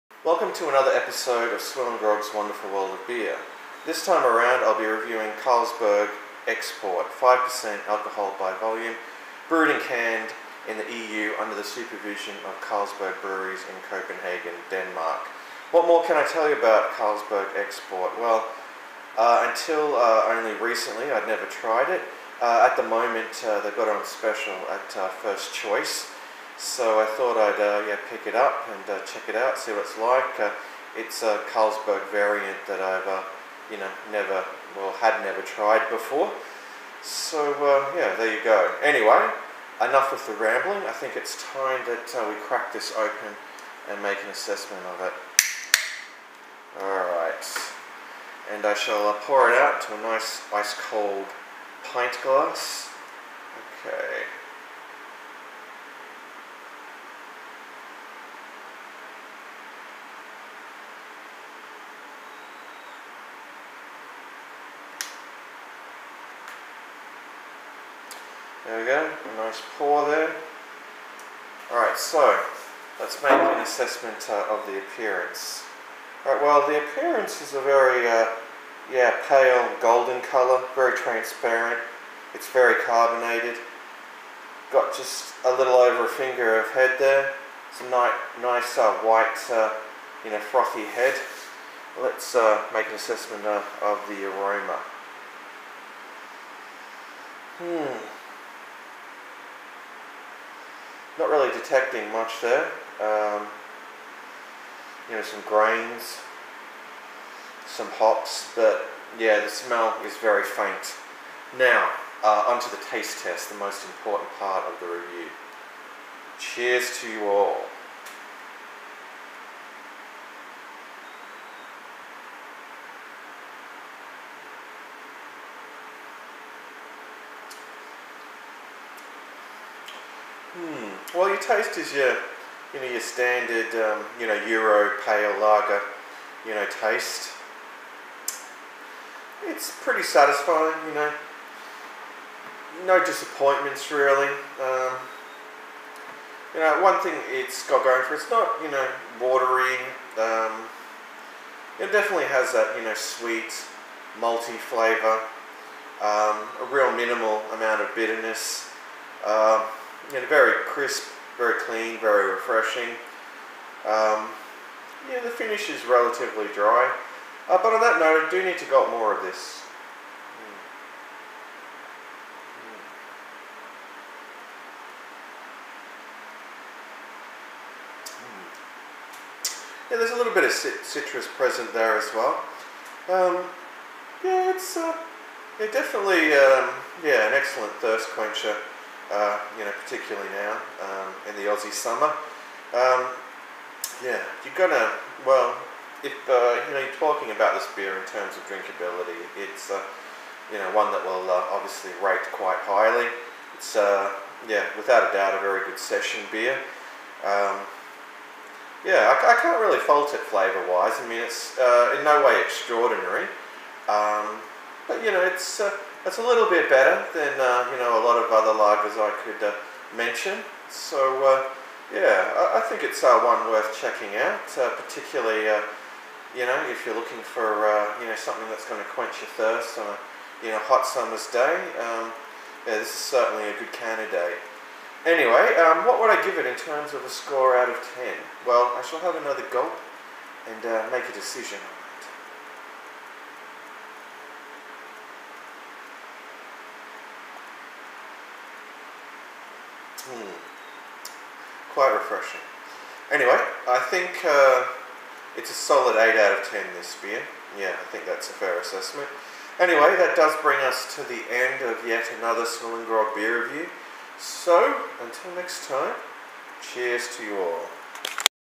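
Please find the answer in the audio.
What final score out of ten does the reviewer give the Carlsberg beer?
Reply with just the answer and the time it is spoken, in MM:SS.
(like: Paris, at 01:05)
8, at 04:15.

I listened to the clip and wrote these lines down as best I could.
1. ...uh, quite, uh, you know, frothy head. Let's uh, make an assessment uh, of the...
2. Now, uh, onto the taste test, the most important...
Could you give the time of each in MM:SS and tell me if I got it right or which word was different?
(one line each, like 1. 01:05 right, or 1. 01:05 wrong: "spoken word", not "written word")
1. 01:28 wrong: "white", not "quite"
2. 01:51 right.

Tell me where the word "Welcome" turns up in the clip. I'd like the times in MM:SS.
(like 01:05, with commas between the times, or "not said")
00:00.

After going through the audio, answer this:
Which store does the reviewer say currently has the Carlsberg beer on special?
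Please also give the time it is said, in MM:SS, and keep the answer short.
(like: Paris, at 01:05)
First Choice, at 00:25.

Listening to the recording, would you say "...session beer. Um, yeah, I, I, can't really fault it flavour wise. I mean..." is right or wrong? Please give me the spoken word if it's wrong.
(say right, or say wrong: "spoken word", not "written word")
right.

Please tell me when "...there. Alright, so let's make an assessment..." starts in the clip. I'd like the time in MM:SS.
01:10.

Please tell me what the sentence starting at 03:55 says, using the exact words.
Anyway, um, what would I give it in terms of a score out of 10?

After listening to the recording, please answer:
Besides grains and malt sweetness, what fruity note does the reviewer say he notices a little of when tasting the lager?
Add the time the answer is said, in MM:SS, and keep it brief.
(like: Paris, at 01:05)
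Citrus, at 03:00.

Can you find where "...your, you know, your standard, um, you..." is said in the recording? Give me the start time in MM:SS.
02:11.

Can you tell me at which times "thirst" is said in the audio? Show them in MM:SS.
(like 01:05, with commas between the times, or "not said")
03:07, 03:49.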